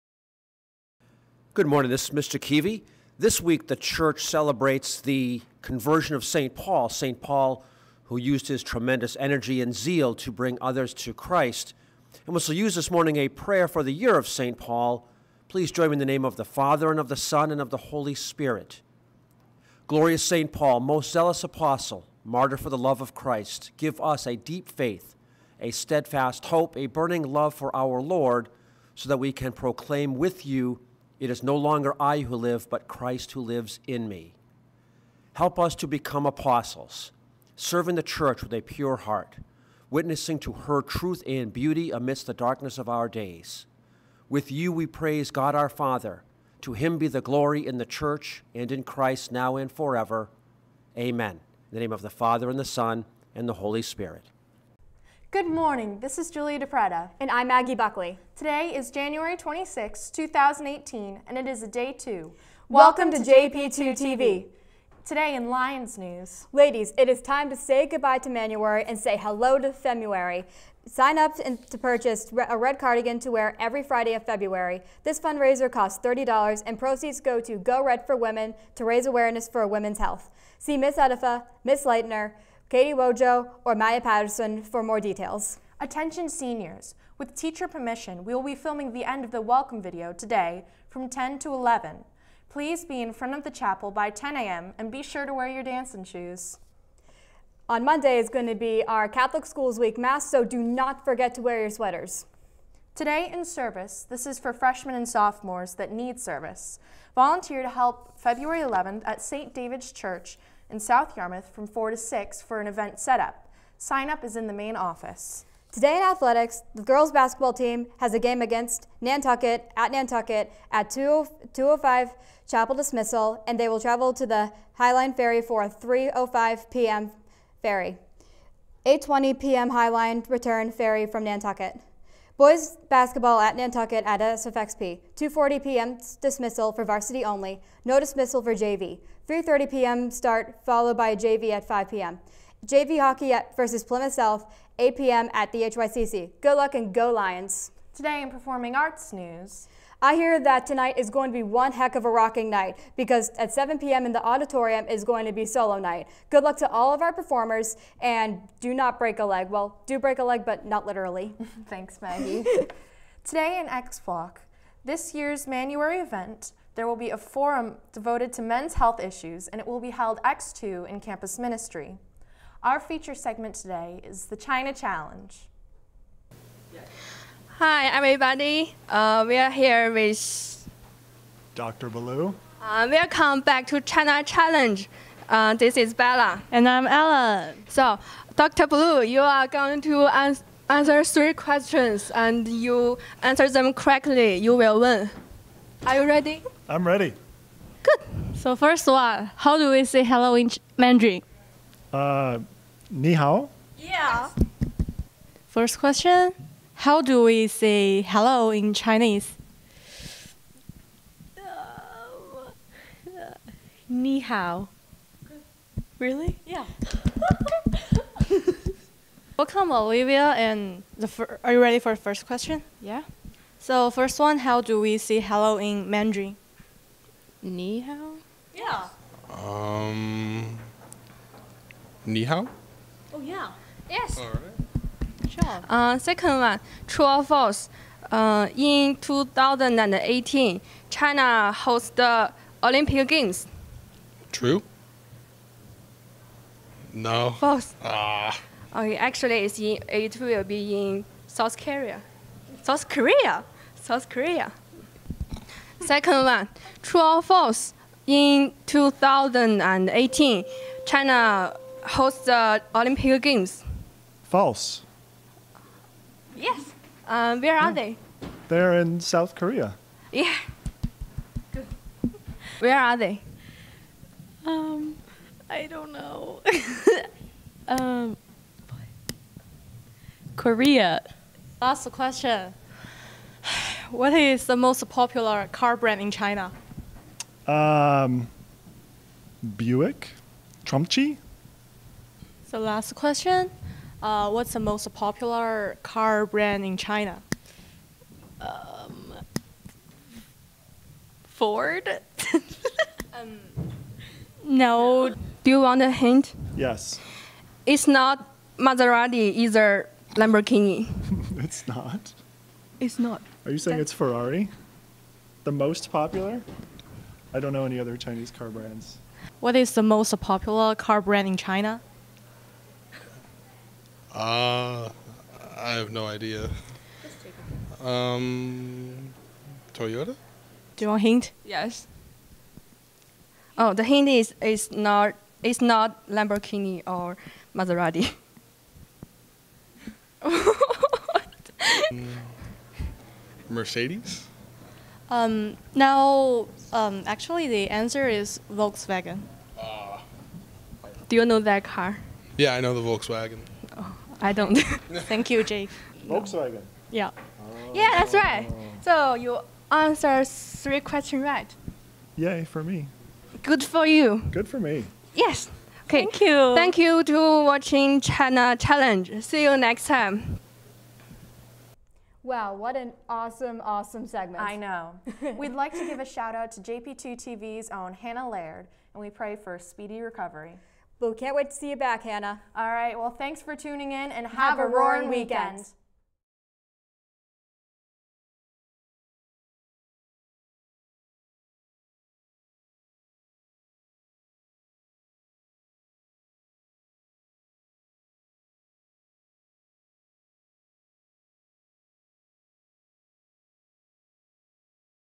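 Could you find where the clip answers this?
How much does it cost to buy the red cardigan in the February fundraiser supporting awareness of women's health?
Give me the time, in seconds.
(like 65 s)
76 s.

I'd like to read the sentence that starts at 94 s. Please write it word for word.
and be sure to wear your dancing shoes.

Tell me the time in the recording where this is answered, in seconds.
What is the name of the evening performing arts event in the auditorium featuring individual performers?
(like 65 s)
155 s.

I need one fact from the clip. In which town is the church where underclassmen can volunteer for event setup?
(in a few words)
South Yarmouth.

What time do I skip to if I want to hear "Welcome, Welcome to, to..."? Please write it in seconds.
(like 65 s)
62 s.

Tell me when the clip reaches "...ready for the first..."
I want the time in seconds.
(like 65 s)
221 s.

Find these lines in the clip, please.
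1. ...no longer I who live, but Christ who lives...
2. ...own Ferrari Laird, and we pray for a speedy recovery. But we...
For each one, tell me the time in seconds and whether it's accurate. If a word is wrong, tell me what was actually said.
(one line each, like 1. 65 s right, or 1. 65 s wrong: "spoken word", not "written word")
1. 31 s right
2. 377 s wrong: "Hannah", not "Ferrari".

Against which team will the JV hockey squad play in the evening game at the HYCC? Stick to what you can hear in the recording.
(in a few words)
Plymouth South.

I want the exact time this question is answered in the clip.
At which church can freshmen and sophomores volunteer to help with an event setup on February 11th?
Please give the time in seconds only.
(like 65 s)
109 s.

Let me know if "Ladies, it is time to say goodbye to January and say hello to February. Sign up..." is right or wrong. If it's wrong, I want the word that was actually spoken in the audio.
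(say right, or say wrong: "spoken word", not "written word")
right.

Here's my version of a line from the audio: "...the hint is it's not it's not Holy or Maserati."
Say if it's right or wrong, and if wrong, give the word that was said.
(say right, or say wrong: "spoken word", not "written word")
wrong: "Lamborghini", not "Holy".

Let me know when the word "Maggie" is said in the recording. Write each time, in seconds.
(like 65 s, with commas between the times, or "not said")
57 s, 162 s.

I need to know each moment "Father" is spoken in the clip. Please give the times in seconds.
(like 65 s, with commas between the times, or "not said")
16 s, 45 s, 52 s.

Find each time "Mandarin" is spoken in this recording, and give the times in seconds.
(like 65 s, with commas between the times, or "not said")
200 s, 225 s.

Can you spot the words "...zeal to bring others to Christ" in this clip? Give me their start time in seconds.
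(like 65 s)
9 s.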